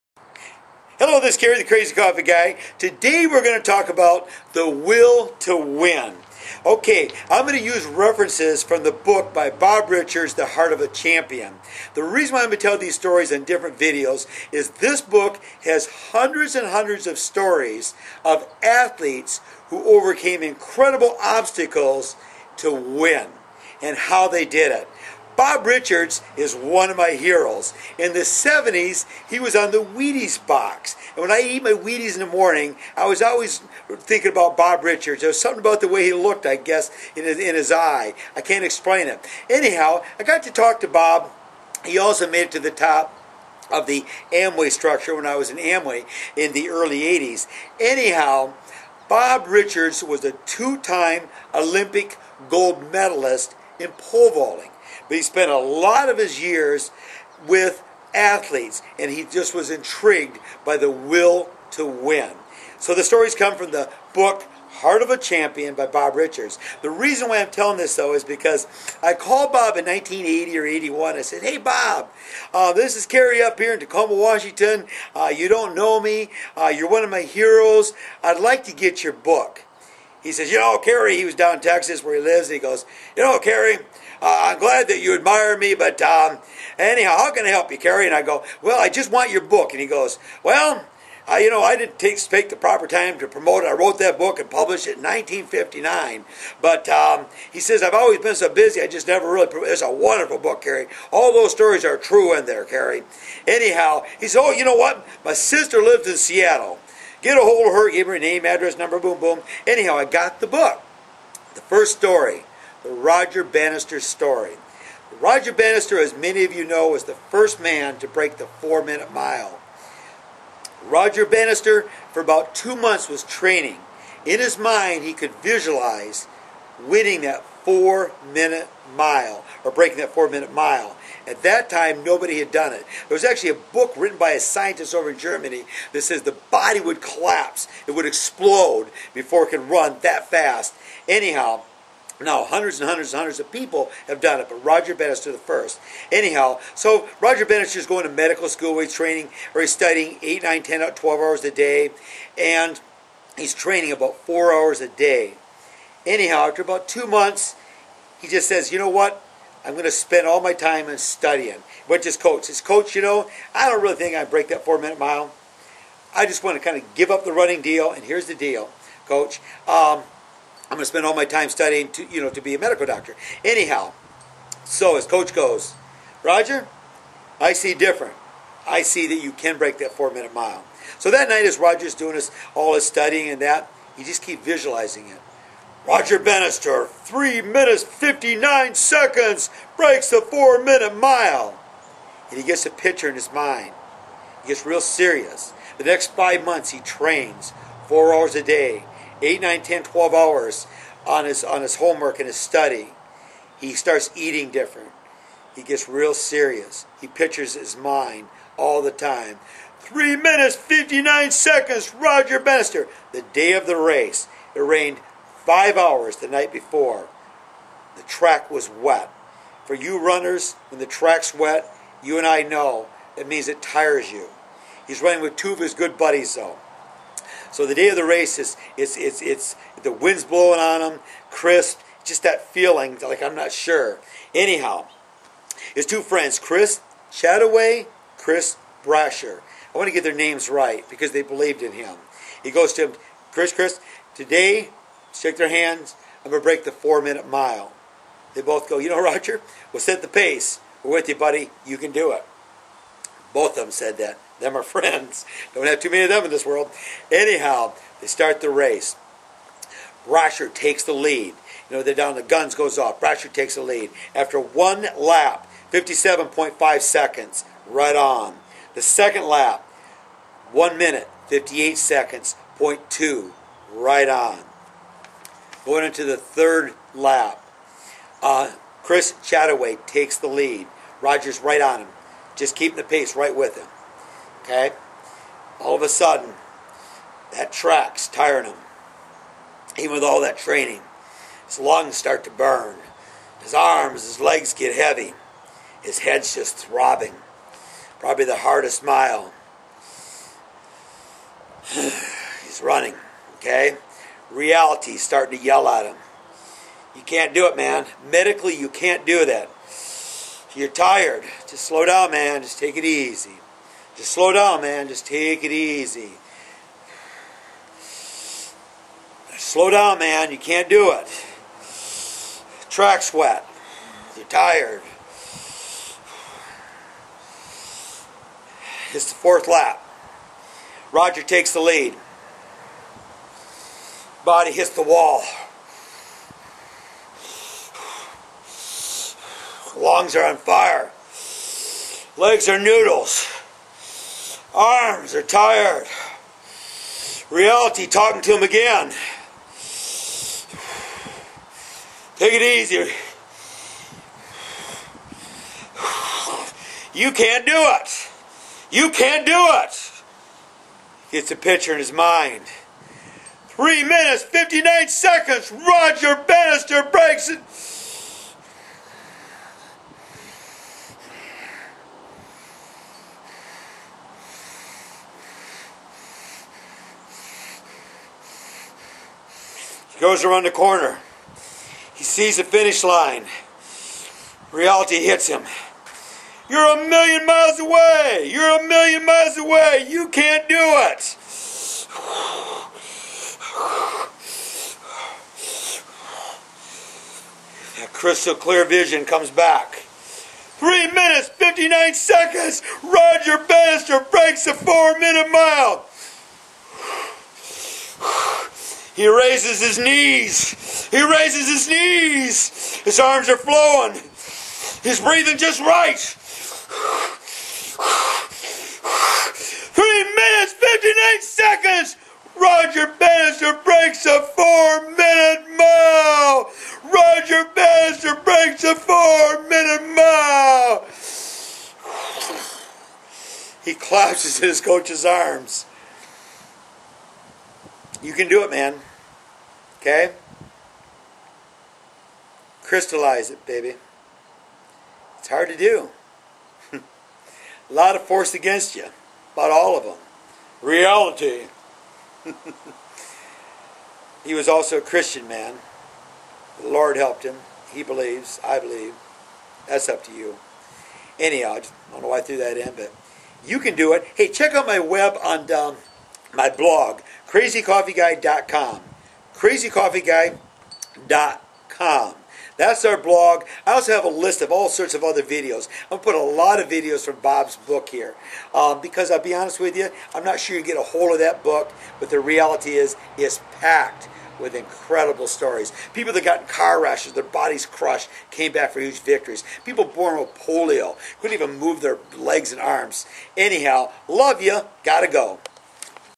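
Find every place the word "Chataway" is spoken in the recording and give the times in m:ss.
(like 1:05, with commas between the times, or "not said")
3:57, 4:39.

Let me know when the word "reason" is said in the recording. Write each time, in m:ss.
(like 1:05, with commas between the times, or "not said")
0:12, 1:06.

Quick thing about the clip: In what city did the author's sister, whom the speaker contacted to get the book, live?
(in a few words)
Seattle.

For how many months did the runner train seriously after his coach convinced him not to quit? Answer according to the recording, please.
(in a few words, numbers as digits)
5.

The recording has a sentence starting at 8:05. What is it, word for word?
People that got in car rashes, their bodies crushed, came back for huge victories.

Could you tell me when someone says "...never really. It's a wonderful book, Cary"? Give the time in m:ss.
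1:39.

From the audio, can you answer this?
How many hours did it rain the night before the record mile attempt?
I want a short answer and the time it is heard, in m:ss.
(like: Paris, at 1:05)
5, at 3:35.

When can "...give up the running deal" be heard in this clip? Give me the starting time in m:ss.
2:46.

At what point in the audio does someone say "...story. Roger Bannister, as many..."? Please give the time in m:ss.
1:53.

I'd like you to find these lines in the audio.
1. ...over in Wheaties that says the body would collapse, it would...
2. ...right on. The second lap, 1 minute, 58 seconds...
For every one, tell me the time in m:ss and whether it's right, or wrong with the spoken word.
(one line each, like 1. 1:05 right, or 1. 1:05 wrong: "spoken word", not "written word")
1. 2:14 wrong: "Germany", not "Wheaties"
2. 4:27 right.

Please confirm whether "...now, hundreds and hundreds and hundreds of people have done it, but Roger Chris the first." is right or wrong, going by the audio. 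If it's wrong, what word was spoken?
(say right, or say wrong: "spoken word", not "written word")
wrong: "Bannister", not "Chris".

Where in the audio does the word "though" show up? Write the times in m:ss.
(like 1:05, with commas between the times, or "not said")
1:07, 3:46.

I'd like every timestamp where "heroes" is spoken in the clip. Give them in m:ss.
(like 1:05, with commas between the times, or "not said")
0:27, 1:17.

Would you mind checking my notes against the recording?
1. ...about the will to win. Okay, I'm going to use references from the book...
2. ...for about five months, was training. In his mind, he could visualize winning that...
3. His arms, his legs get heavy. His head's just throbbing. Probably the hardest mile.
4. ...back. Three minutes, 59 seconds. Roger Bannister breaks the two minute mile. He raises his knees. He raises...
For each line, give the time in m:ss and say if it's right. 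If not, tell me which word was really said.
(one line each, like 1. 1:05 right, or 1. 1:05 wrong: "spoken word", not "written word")
1. 0:03 right
2. 2:02 wrong: "two", not "five"
3. 4:53 right
4. 6:39 wrong: "four", not "two".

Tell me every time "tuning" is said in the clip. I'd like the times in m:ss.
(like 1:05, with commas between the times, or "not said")
not said.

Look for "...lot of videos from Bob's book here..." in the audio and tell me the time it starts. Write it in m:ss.
7:56.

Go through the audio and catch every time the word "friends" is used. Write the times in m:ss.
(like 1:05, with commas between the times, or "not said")
3:56, 4:14.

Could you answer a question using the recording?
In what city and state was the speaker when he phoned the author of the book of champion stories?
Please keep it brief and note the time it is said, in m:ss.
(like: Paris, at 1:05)
Tacoma, Washington, at 1:13.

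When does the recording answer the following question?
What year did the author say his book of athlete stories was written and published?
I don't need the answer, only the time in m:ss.
1:35.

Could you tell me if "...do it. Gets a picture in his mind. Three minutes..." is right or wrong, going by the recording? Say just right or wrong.
right.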